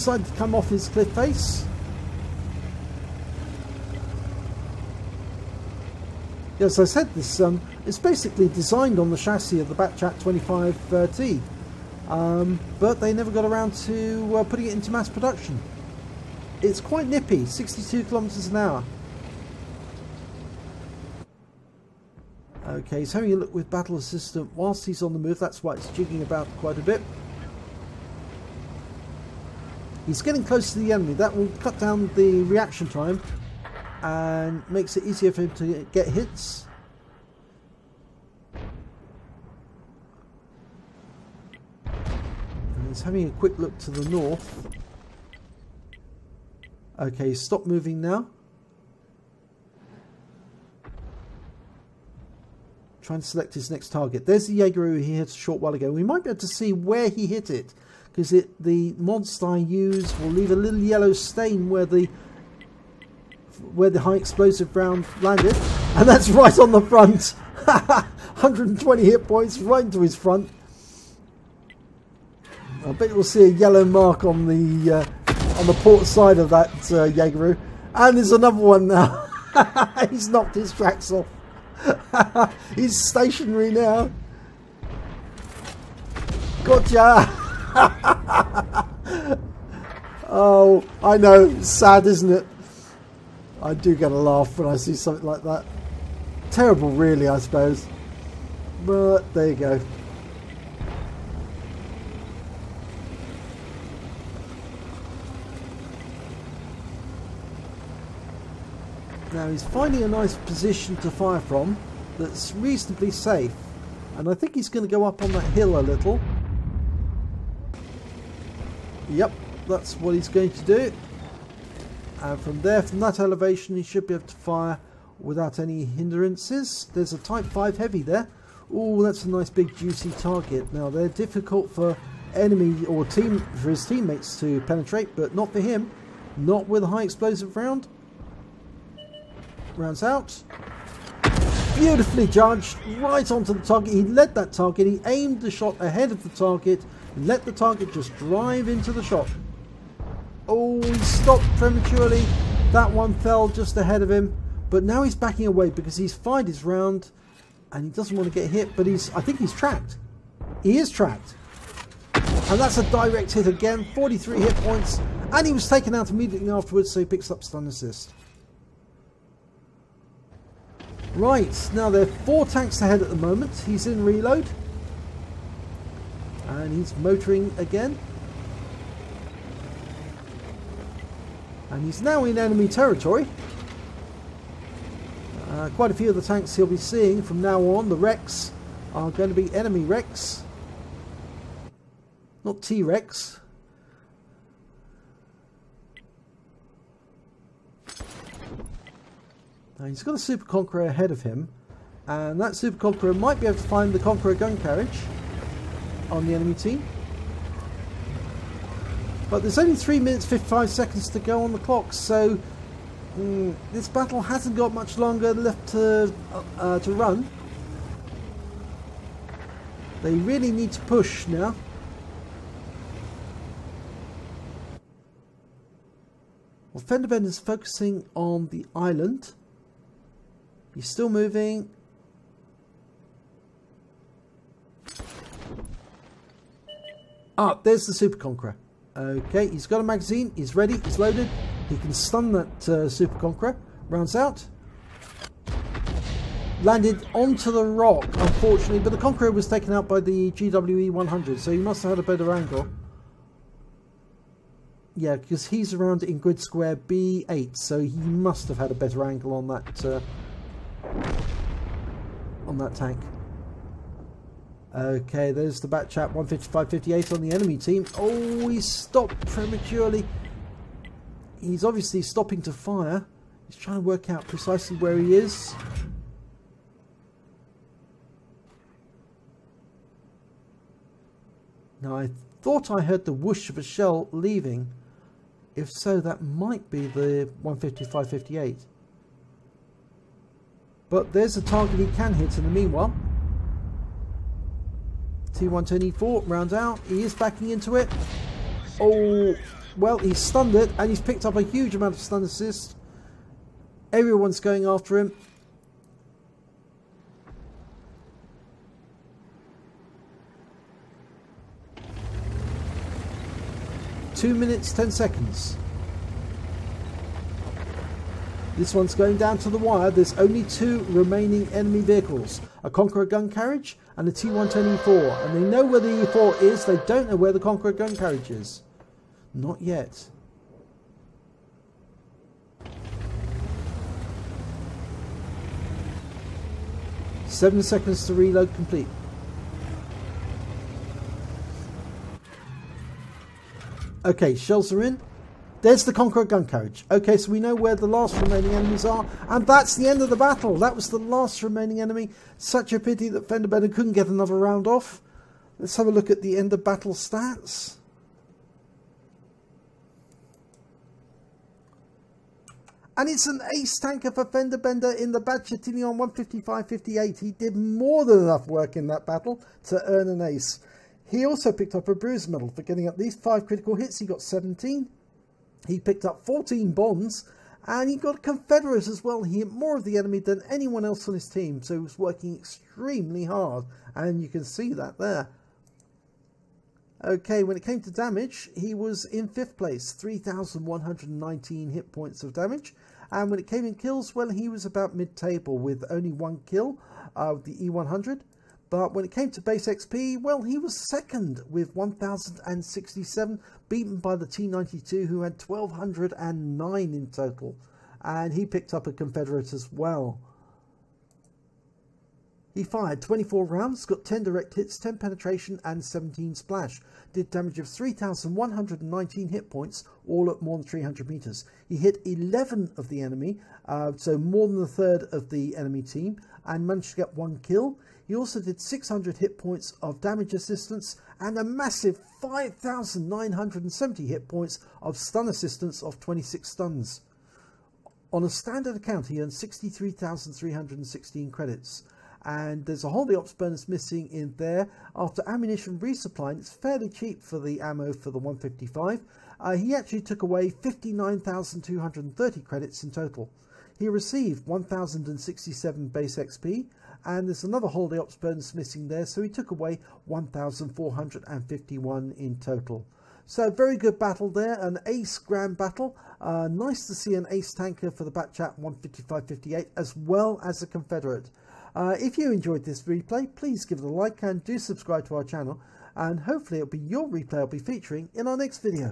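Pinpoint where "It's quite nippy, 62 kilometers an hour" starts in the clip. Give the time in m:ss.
0:16.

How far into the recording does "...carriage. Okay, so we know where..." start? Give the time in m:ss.
5:46.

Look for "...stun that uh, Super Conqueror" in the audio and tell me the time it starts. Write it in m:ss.
4:01.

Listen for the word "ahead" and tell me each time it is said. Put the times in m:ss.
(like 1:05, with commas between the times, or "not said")
2:25, 2:33, 2:52, 3:20.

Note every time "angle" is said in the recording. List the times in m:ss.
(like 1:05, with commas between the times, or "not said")
4:12, 4:19.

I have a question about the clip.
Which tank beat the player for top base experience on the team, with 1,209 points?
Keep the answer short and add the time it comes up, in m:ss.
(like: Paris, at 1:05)
T92, at 6:44.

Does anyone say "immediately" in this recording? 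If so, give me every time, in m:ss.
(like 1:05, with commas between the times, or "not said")
2:46.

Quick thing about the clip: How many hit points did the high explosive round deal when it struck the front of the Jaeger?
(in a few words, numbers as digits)
120.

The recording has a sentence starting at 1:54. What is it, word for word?
And I think he's going to go up on that hill a little.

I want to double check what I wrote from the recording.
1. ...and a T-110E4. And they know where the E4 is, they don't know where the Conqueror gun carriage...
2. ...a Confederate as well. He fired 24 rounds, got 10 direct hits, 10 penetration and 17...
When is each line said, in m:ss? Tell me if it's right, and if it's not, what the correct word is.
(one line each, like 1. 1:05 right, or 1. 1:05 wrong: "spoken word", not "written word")
1. 5:23 right
2. 6:48 right.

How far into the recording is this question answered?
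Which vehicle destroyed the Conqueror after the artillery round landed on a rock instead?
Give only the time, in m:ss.
4:10.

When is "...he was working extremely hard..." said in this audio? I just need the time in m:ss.
6:21.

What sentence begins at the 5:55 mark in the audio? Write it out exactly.
Let's have a look at the end of battle stats.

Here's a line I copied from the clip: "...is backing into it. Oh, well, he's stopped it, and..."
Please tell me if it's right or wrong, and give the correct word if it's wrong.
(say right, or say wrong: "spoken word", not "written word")
wrong: "stunned", not "stopped".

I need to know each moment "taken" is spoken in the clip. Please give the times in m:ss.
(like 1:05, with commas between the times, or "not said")
2:45, 4:09.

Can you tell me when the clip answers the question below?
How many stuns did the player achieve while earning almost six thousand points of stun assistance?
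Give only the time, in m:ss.
7:16.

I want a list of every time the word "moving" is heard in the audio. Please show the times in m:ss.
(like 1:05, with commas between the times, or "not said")
0:47, 3:51.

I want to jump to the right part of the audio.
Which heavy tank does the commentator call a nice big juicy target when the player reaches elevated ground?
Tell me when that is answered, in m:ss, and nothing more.
2:07.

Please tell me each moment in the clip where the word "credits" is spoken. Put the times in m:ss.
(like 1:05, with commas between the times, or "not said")
7:21, 7:32.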